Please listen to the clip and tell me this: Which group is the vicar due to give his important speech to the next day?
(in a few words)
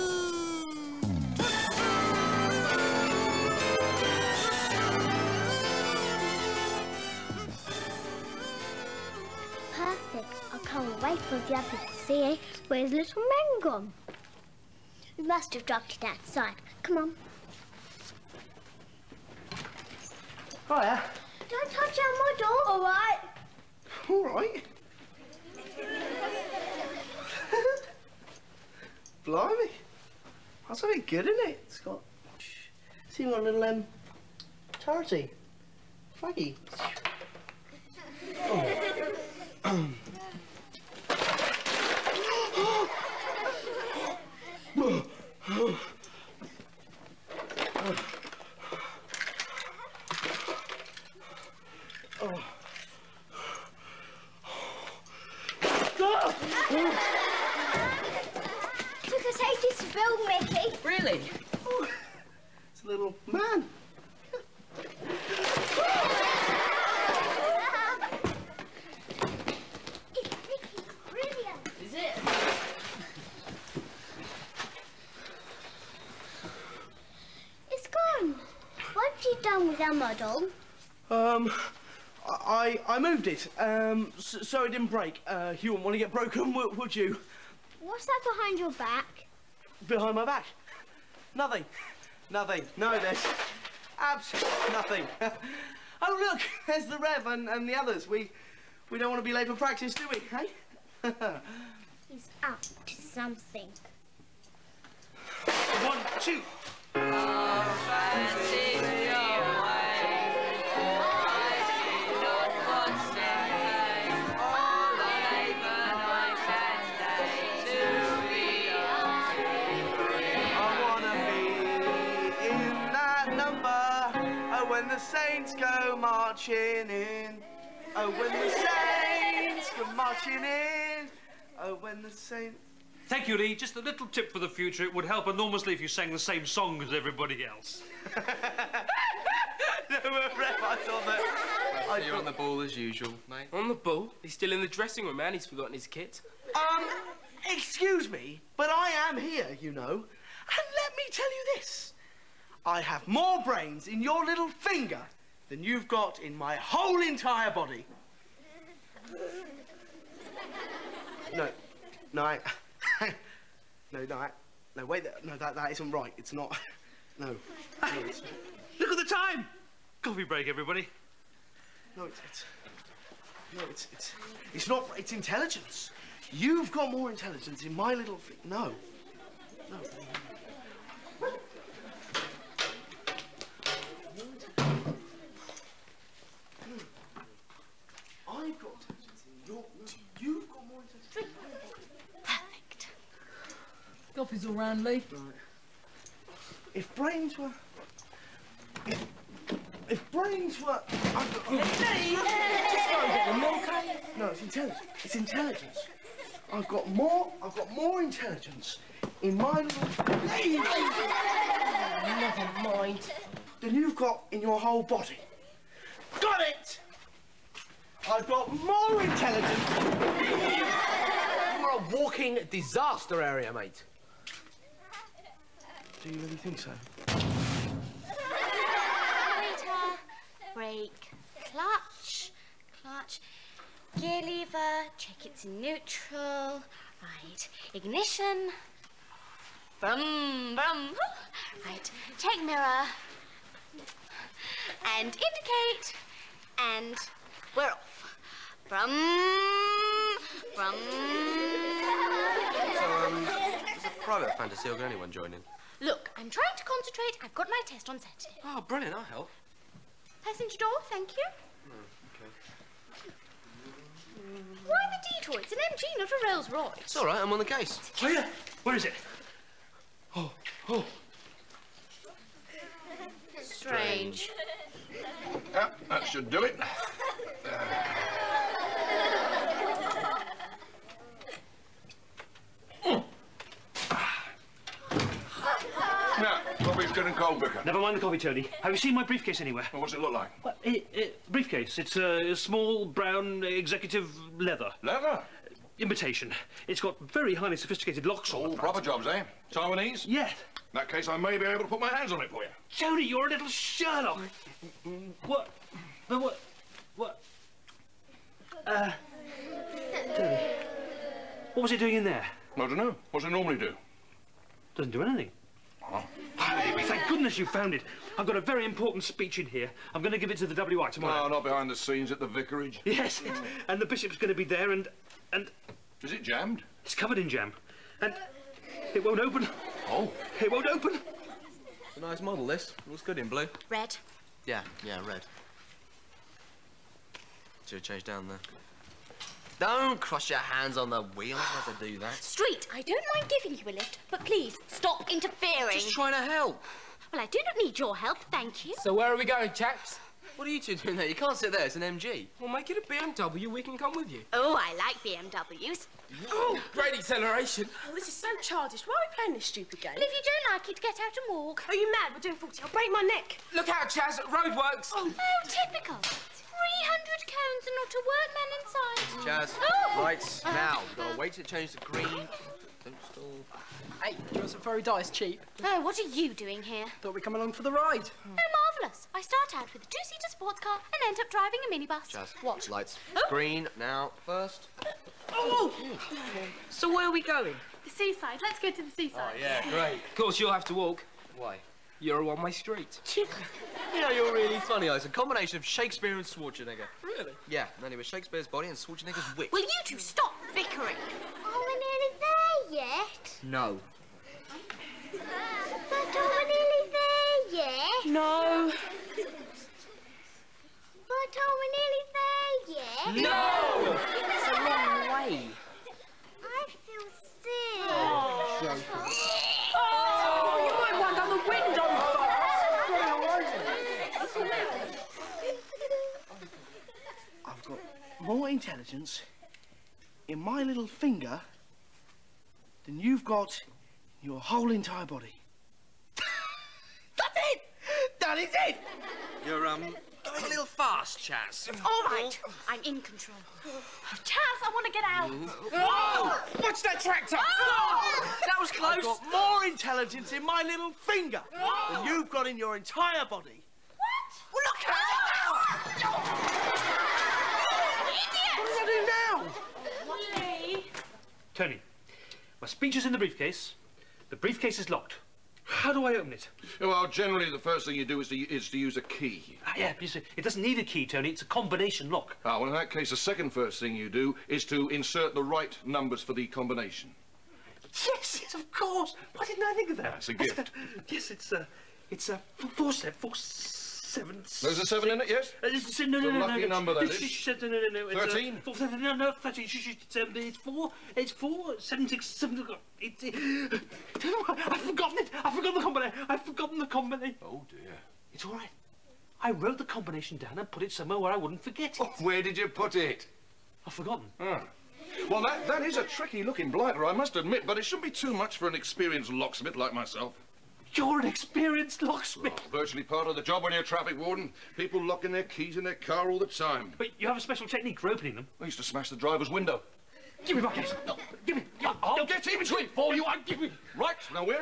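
the WI.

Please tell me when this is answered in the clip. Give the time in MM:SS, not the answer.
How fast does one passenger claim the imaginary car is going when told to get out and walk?
06:02.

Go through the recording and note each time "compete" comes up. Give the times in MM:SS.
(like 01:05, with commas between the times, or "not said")
not said.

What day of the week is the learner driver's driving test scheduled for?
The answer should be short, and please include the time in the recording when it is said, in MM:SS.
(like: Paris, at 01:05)
Saturday, at 04:17.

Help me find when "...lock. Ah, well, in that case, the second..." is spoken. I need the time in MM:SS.
07:52.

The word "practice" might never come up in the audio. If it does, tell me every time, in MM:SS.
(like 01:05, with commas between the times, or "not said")
01:39.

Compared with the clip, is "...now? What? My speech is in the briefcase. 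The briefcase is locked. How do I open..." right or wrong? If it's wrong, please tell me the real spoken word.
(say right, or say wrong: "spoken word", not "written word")
right.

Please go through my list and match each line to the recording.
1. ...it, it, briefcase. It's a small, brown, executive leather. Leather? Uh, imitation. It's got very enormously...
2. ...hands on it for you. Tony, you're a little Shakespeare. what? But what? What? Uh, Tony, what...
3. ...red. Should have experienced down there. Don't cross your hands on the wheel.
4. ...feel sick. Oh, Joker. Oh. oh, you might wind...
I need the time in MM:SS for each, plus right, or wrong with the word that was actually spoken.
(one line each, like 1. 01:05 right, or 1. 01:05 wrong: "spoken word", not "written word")
1. 04:50 wrong: "highly", not "enormously"
2. 05:01 wrong: "Sherlock", not "Shakespeare"
3. 05:35 wrong: "changed", not "experienced"
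4. 06:56 right.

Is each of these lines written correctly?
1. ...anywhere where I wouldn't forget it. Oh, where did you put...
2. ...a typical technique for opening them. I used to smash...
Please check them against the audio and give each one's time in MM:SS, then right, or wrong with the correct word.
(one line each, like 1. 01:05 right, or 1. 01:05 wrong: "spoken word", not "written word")
1. 08:20 wrong: "somewhere", not "anywhere"
2. 08:37 wrong: "special", not "typical".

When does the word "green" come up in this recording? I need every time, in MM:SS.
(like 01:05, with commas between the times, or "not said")
06:11, 06:23.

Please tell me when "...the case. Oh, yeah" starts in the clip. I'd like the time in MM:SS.
04:27.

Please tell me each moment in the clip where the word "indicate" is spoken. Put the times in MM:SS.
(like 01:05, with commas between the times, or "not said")
04:05.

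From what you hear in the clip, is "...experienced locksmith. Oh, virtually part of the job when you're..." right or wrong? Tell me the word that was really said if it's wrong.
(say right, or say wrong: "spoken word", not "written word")
right.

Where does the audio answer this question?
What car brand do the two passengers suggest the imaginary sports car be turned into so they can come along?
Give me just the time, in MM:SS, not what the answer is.
05:52.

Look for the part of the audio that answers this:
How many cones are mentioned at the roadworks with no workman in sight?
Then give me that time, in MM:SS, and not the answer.
06:05.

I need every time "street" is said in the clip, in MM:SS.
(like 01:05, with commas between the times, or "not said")
05:42, 06:32.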